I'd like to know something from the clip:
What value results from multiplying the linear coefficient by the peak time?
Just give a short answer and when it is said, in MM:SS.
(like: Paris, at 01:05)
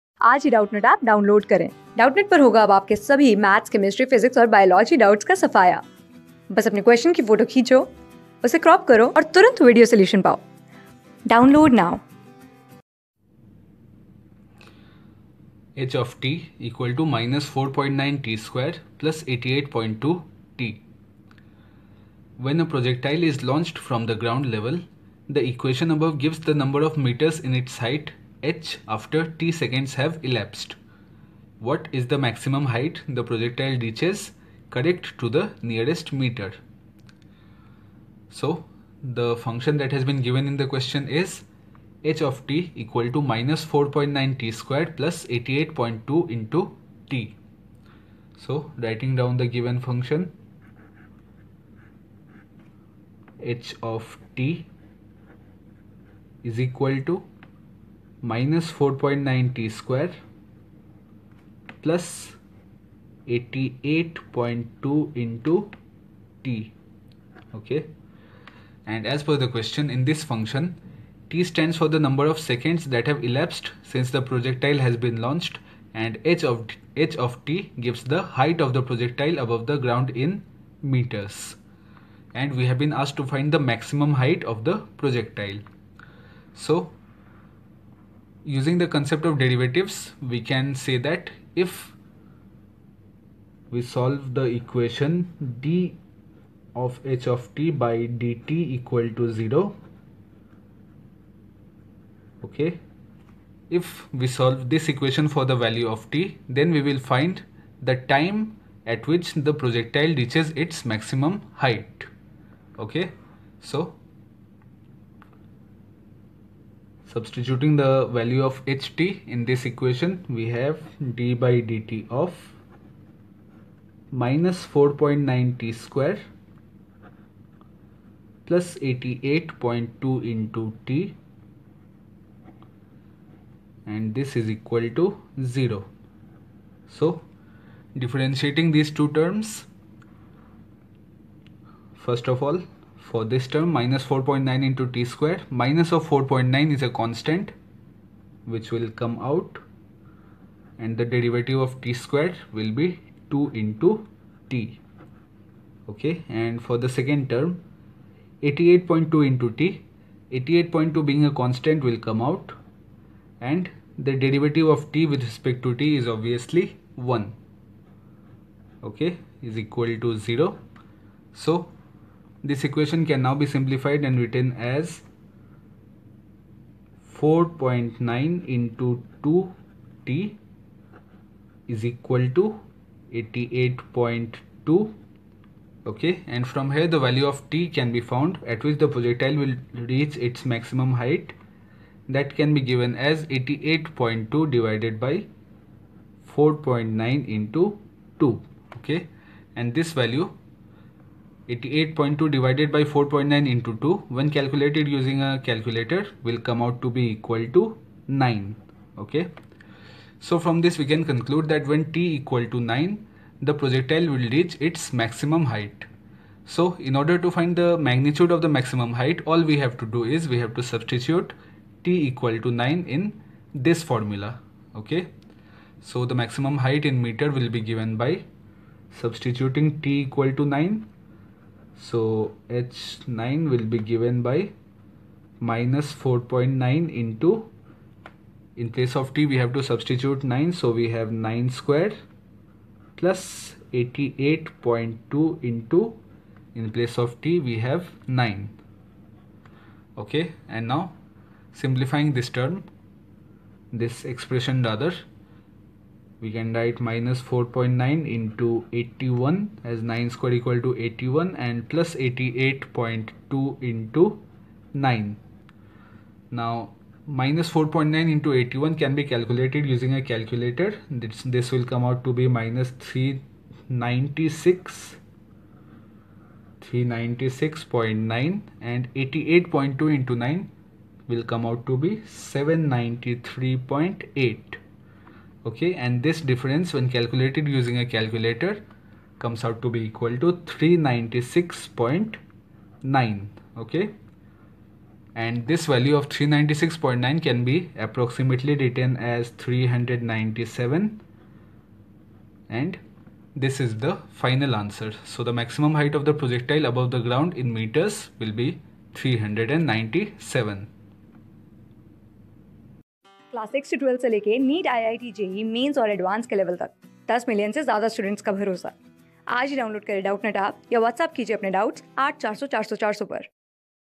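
793.8, at 04:42.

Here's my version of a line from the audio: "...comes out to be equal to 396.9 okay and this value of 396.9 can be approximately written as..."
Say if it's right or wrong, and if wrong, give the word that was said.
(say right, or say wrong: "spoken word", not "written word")
right.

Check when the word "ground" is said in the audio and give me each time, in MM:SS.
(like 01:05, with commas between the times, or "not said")
01:19, 05:06.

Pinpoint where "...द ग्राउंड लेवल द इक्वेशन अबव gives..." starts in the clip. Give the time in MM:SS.
00:24.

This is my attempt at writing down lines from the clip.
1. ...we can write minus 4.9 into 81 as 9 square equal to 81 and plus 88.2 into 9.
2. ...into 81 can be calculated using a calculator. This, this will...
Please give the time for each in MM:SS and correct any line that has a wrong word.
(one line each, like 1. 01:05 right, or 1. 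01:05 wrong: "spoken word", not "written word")
1. 04:16 right
2. 04:28 right.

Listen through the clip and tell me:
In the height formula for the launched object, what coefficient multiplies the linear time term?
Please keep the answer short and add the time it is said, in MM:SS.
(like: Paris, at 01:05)
88.2, at 00:19.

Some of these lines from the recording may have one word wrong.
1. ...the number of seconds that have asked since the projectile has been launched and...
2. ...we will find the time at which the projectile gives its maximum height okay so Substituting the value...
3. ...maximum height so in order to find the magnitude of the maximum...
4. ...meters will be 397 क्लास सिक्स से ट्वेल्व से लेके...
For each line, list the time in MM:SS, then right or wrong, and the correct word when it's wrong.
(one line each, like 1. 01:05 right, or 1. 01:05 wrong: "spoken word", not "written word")
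1. 01:11 wrong: "elapsed", not "asked"
2. 01:46 wrong: "reaches", not "gives"
3. 03:34 right
4. 05:07 right.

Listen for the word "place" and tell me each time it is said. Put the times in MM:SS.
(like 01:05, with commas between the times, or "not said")
03:58, 04:06.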